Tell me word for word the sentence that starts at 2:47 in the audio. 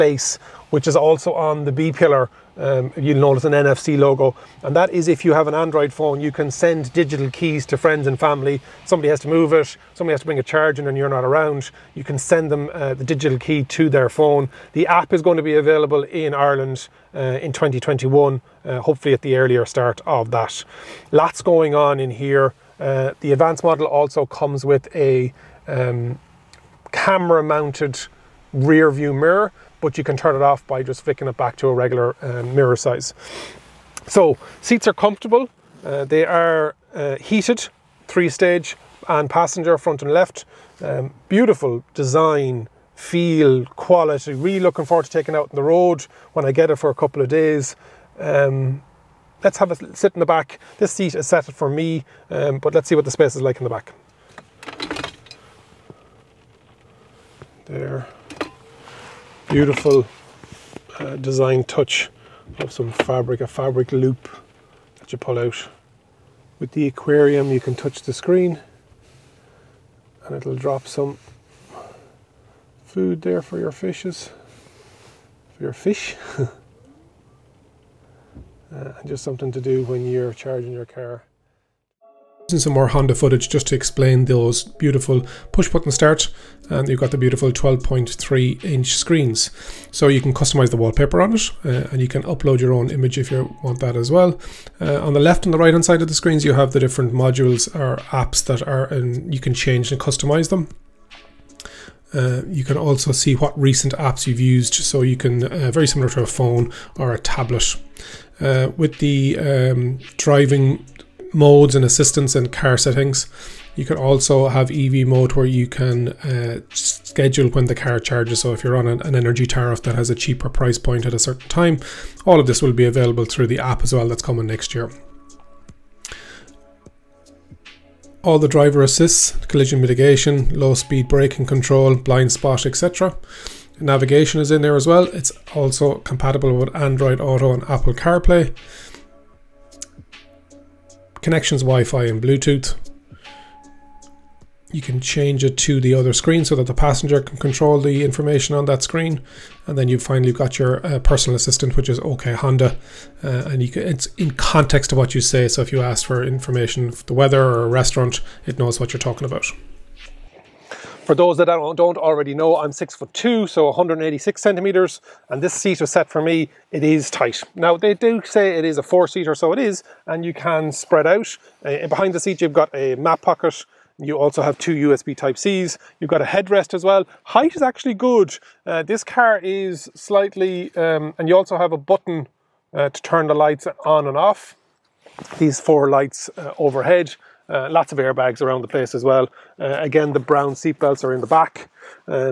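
Now they do say it is a four seater, so it is, and you can spread out.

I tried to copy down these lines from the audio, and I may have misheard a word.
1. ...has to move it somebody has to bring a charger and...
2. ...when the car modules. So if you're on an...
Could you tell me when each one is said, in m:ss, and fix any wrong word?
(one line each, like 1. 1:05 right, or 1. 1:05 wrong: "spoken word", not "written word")
1. 0:09 right
2. 1:57 wrong: "charges", not "modules".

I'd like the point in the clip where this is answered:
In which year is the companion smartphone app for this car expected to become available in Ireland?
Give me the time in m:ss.
0:17.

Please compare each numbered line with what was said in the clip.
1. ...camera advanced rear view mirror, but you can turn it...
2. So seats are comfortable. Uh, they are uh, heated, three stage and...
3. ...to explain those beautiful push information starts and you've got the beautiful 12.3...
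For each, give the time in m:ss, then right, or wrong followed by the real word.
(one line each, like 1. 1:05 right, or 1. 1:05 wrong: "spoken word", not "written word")
1. 0:26 wrong: "mounted", not "advanced"
2. 0:34 right
3. 1:23 wrong: "button", not "information".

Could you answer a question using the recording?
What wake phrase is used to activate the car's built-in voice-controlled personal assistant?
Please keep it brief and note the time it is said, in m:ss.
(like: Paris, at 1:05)
OK Honda, at 2:32.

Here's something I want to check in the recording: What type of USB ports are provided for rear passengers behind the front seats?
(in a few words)
USB type C.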